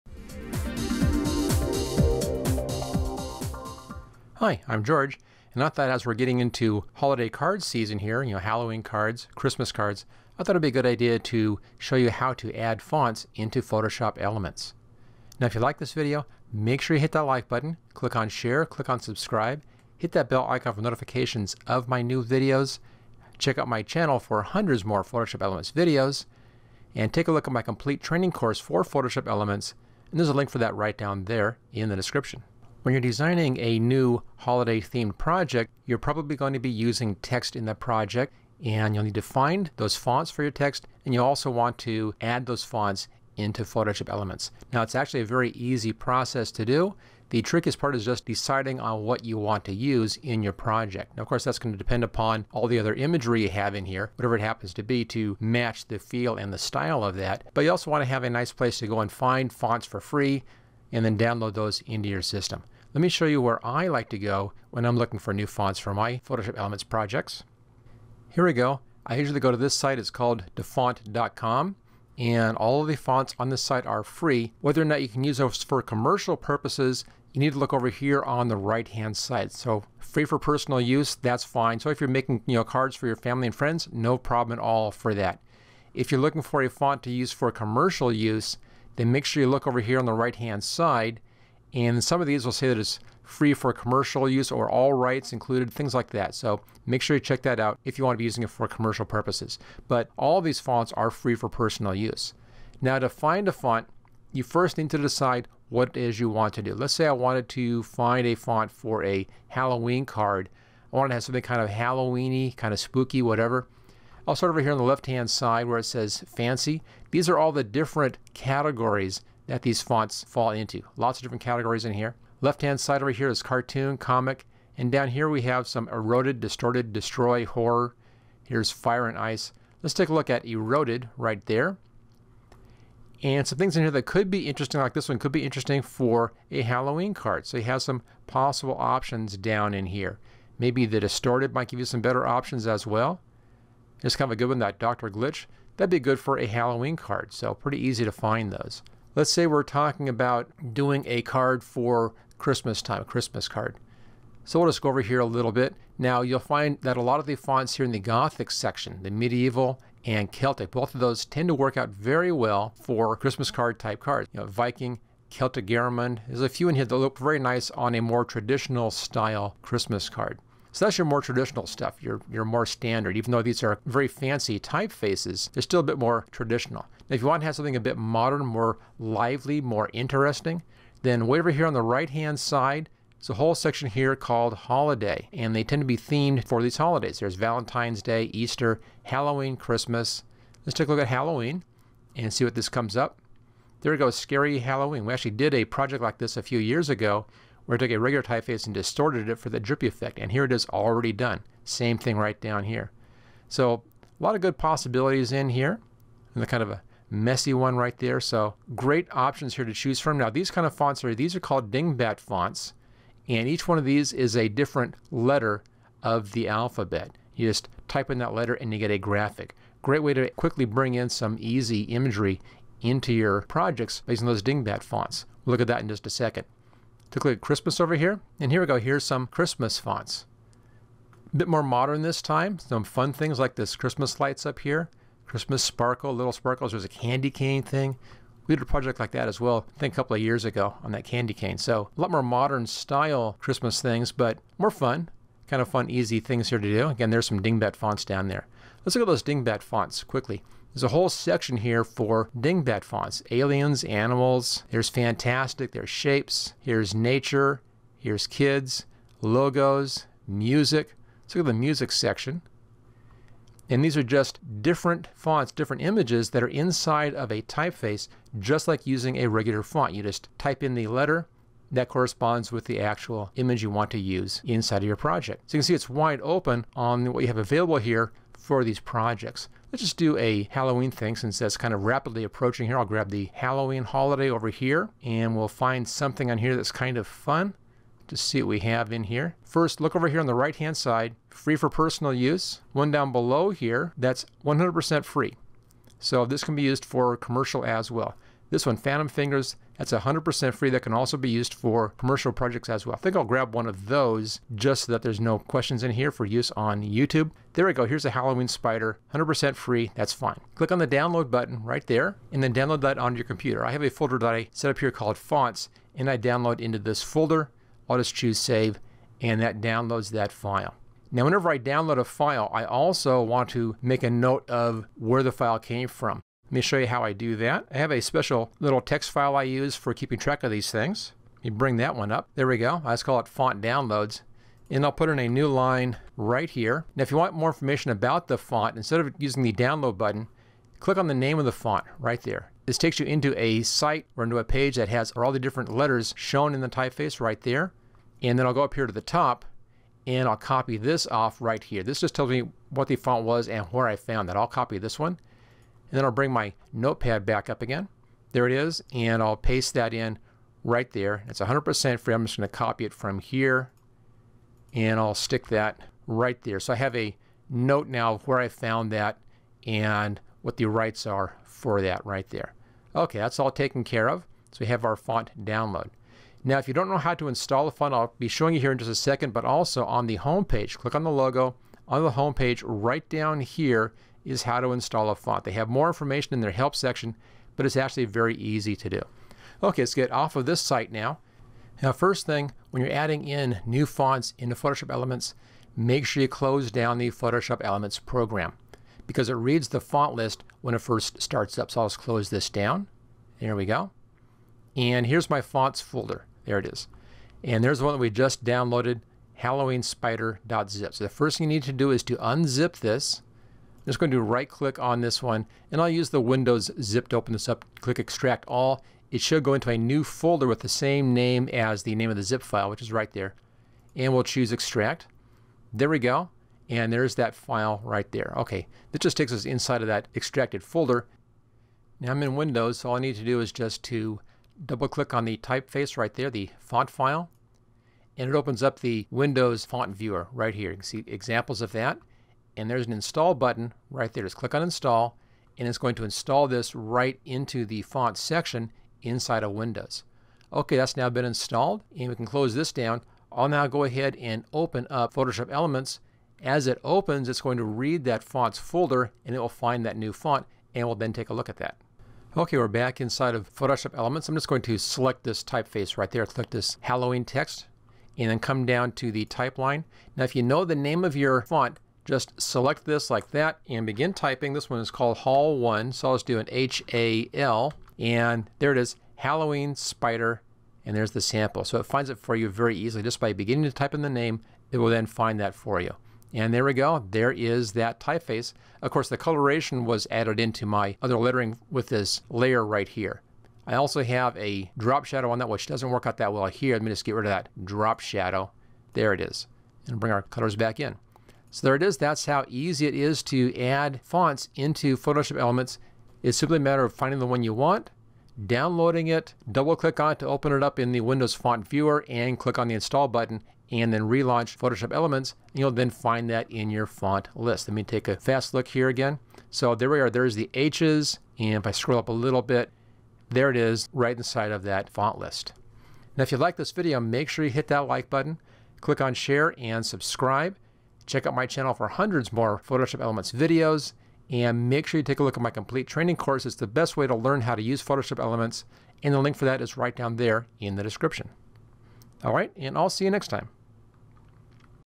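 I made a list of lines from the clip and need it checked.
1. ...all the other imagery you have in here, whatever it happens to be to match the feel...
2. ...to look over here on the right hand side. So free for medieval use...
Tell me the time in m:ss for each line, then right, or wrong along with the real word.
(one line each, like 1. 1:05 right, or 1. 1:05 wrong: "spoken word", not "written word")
1. 0:52 right
2. 1:17 wrong: "personal", not "medieval".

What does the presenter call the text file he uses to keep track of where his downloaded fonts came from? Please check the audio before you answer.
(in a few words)
font downloads.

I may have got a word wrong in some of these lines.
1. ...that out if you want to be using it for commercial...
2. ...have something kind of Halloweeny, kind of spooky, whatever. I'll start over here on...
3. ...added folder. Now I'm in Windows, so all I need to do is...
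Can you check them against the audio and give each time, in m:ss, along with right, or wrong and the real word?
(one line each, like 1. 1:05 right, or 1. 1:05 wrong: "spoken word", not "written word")
1. 1:37 right
2. 1:51 right
3. 7:10 wrong: "extracted", not "added".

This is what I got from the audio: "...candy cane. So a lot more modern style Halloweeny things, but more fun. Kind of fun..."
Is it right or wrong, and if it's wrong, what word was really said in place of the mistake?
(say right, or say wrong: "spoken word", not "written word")
wrong: "Christmas", not "Halloweeny".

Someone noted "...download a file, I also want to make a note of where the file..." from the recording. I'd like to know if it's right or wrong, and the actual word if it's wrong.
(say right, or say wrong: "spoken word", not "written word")
right.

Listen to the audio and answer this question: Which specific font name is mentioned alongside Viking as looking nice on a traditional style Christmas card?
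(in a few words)
Celtic Garamond.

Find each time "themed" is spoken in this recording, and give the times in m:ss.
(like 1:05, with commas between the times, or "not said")
0:34, 3:05.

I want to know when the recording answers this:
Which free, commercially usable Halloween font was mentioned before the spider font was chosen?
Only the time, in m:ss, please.
4:58.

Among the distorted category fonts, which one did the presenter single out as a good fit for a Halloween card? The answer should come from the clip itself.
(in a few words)
Dr. Glitch.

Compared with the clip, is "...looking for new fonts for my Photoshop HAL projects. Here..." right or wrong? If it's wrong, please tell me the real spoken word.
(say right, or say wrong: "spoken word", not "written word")
wrong: "Elements", not "HAL".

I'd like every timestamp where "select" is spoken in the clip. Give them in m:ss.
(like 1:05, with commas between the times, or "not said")
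7:44, 7:52.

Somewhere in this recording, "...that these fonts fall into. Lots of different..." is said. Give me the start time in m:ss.
1:59.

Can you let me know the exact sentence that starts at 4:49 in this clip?
First, look over here on the right hand side, free for personal use.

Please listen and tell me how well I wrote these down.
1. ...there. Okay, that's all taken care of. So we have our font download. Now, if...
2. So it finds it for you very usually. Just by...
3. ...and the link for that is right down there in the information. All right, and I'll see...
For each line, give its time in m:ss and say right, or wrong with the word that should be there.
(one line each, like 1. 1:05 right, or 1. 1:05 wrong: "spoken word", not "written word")
1. 6:12 right
2. 8:01 wrong: "easily", not "usually"
3. 8:59 wrong: "description", not "information".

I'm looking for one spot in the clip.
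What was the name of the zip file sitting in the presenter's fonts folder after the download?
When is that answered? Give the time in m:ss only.
6:49.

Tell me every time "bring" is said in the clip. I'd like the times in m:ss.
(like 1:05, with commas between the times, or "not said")
3:40, 5:31, 5:56, 8:19.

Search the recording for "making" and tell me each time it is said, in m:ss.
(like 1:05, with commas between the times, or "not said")
1:22.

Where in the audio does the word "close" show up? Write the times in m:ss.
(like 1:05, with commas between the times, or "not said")
6:36, 6:41, 7:32.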